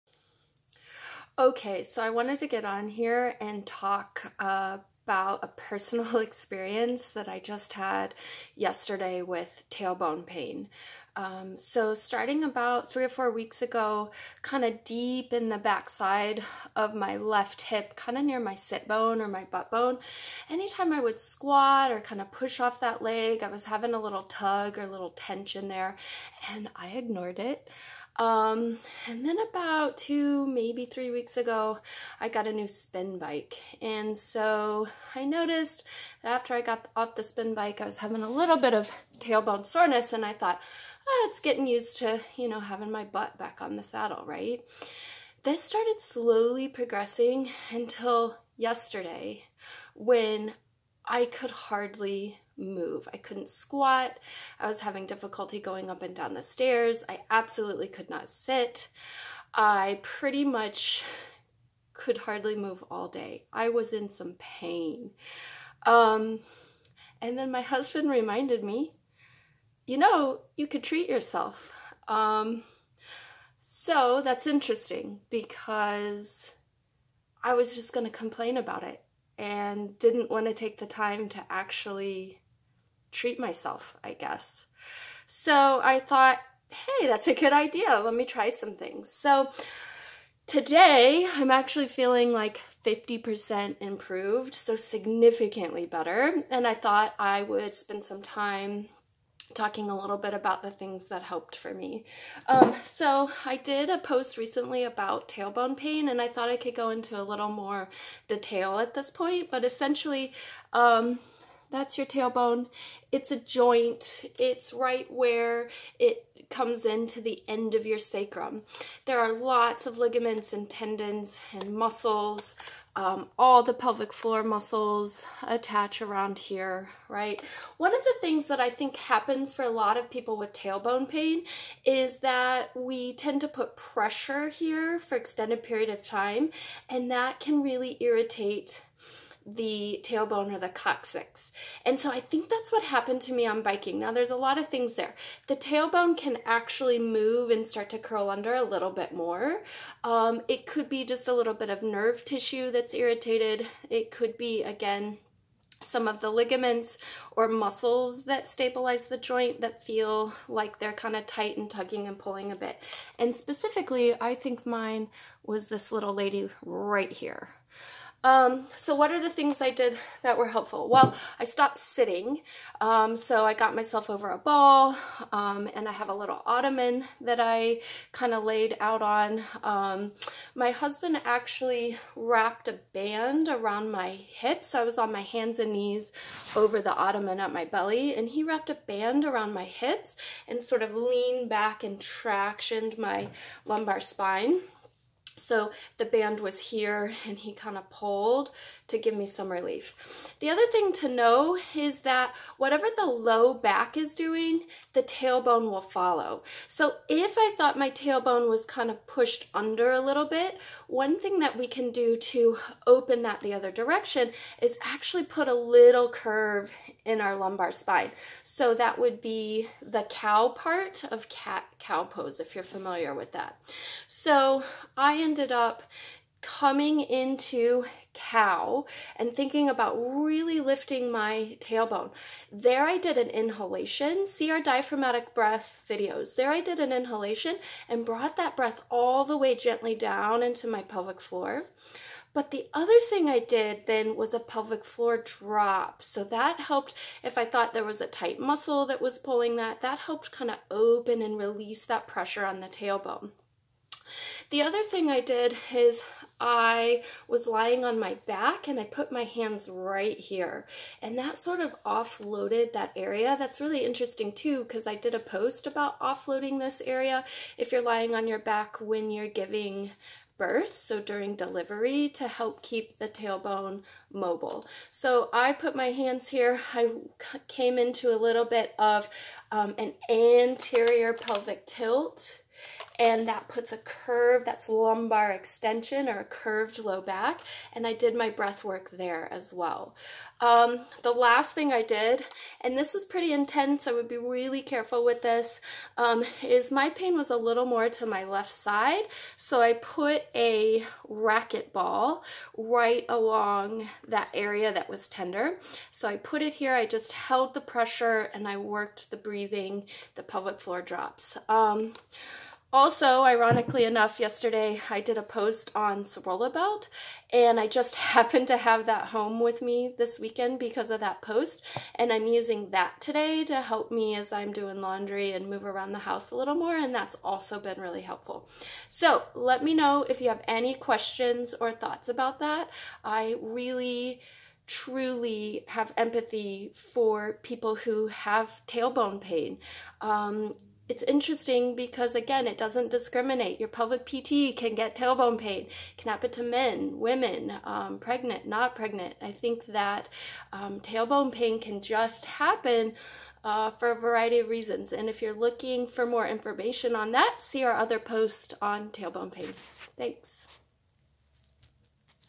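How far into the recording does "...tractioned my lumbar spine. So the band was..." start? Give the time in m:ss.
3:11.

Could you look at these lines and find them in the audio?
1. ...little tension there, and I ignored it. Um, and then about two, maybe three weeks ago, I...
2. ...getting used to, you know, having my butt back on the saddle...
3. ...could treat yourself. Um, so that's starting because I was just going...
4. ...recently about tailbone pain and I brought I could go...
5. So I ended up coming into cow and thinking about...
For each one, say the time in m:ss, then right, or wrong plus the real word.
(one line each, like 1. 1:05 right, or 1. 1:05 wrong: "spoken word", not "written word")
1. 0:24 right
2. 0:41 right
3. 1:10 wrong: "interesting", not "starting"
4. 1:44 wrong: "thought", not "brought"
5. 3:44 right.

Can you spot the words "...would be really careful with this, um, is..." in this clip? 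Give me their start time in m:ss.
4:53.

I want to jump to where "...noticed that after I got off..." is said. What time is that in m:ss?
0:35.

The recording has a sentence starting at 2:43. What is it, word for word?
And specifically, I think mine was this little lady right here.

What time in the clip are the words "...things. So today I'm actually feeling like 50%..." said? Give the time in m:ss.
1:28.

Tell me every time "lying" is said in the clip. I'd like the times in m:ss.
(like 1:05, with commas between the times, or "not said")
4:17, 4:27.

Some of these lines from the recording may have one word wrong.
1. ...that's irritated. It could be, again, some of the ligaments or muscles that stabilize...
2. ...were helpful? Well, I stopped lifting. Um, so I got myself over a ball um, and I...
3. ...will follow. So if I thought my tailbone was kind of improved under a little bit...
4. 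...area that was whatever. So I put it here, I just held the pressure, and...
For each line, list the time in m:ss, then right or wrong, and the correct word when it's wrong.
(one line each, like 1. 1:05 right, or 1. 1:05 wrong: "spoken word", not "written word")
1. 2:32 right
2. 2:50 wrong: "sitting", not "lifting"
3. 3:25 wrong: "pushed", not "improved"
4. 5:04 wrong: "tender", not "whatever".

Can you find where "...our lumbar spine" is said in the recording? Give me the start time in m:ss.
3:37.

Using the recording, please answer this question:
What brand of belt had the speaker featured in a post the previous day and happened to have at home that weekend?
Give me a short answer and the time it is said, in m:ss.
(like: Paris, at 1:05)
Serola, at 5:16.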